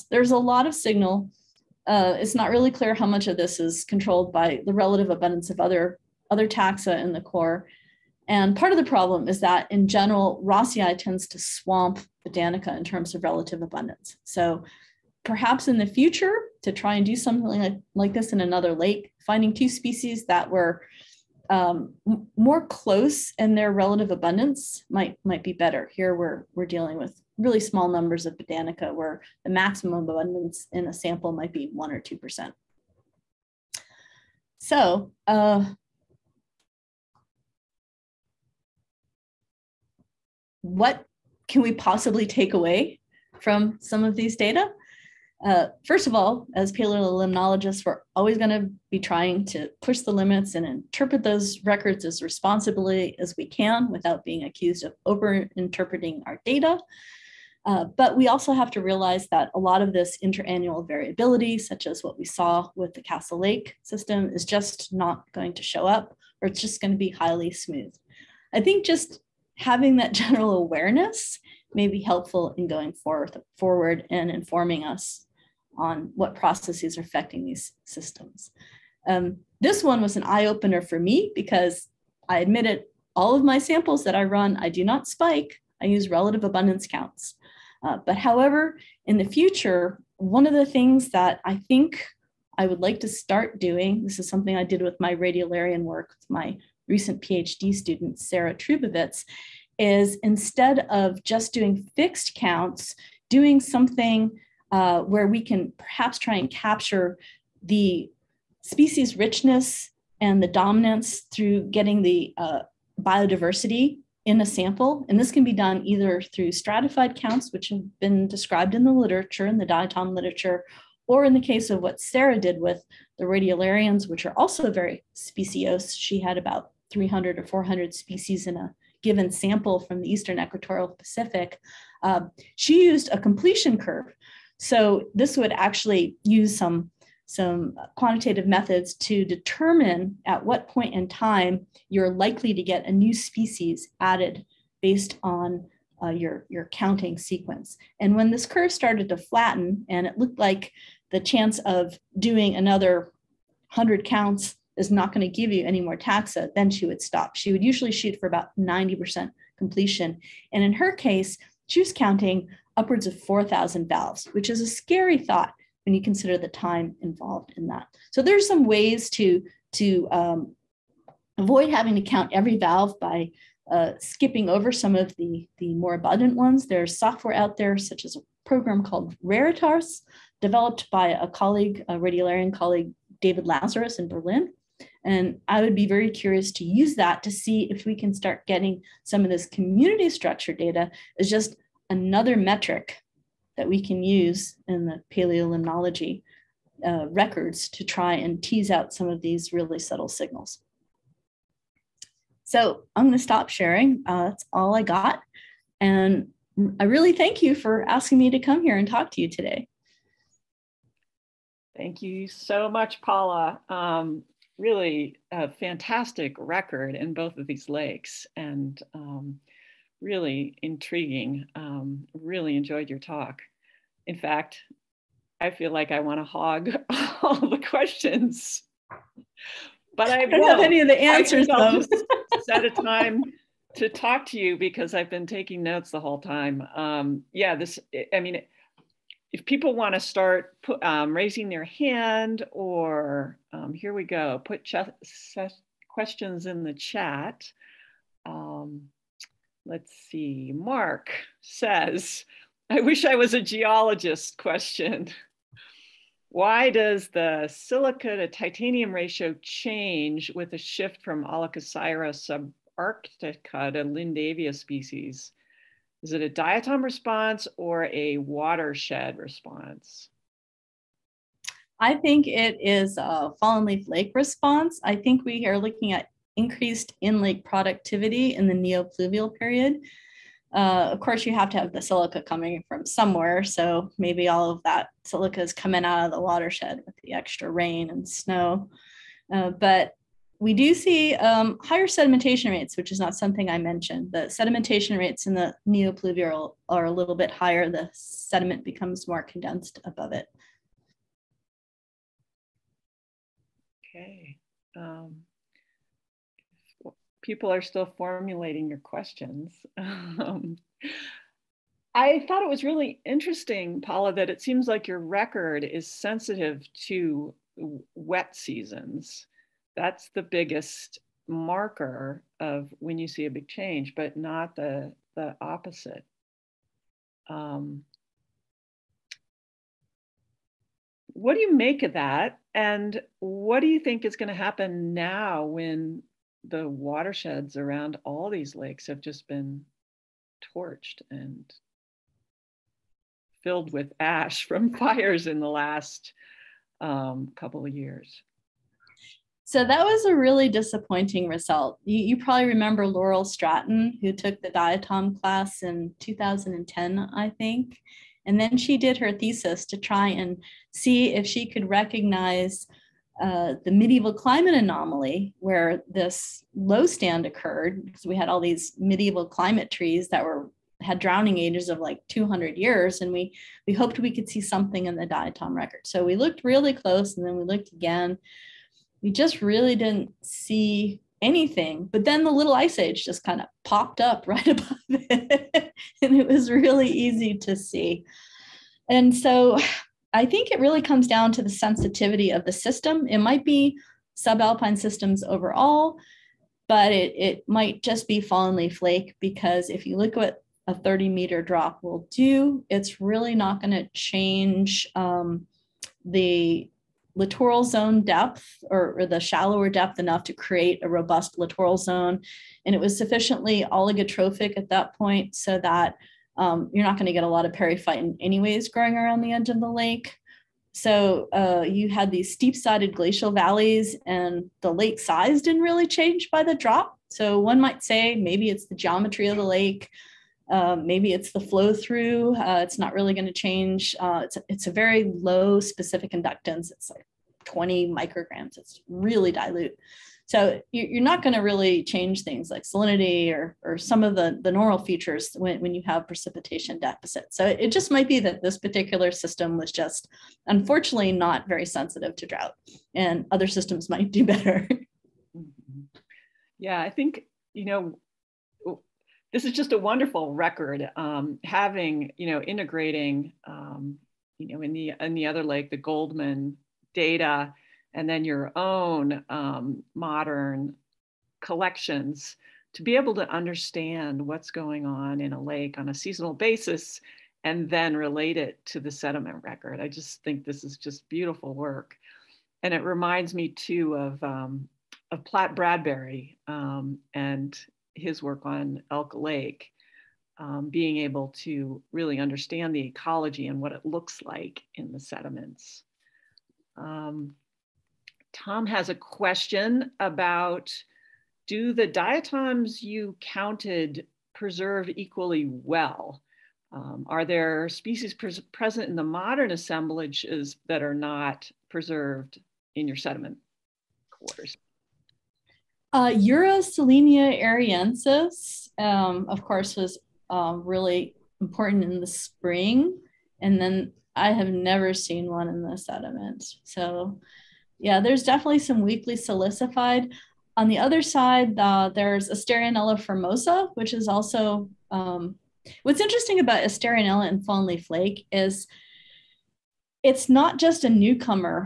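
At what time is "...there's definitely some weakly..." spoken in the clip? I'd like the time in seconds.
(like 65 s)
527 s.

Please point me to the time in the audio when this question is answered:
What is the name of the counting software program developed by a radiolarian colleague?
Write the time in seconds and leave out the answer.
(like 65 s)
179 s.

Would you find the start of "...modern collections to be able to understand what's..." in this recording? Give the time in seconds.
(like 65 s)
469 s.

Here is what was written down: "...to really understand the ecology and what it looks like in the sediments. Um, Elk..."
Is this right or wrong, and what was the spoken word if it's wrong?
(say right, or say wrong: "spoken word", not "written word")
wrong: "Tom", not "Elk".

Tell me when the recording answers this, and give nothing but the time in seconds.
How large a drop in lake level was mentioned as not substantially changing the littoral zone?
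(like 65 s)
400 s.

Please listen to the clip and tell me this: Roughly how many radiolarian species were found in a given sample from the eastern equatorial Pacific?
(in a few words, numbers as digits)
300 or 400.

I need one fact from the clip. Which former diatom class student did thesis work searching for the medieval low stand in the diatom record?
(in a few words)
Laurel Stratton.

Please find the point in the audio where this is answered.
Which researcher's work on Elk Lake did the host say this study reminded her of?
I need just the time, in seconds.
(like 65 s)
485 s.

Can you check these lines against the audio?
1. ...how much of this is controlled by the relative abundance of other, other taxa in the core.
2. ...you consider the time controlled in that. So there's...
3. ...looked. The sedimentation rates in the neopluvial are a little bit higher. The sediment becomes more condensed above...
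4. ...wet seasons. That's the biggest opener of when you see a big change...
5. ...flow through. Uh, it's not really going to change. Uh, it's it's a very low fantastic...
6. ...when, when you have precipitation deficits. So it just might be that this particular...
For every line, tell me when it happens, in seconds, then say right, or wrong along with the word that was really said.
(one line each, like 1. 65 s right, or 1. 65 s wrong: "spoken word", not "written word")
1. 2 s right
2. 165 s wrong: "involved", not "controlled"
3. 293 s wrong: "mentioned", not "looked"
4. 317 s wrong: "marker", not "opener"
5. 431 s wrong: "specific", not "fantastic"
6. 445 s right.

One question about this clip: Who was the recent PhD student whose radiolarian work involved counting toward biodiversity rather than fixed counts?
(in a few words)
Sarah Trubovitz.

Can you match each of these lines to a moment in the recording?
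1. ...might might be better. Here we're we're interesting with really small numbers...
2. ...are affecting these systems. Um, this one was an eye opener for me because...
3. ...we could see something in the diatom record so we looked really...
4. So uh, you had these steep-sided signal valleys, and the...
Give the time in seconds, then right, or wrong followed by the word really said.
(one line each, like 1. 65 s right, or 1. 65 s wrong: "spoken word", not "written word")
1. 24 s wrong: "dealing", not "interesting"
2. 76 s right
3. 373 s right
4. 420 s wrong: "glacial", not "signal".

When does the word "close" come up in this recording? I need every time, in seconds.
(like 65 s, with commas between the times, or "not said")
22 s, 376 s.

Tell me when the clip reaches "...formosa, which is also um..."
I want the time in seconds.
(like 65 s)
532 s.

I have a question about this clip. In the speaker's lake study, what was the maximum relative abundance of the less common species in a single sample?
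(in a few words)
1 or 2 percent.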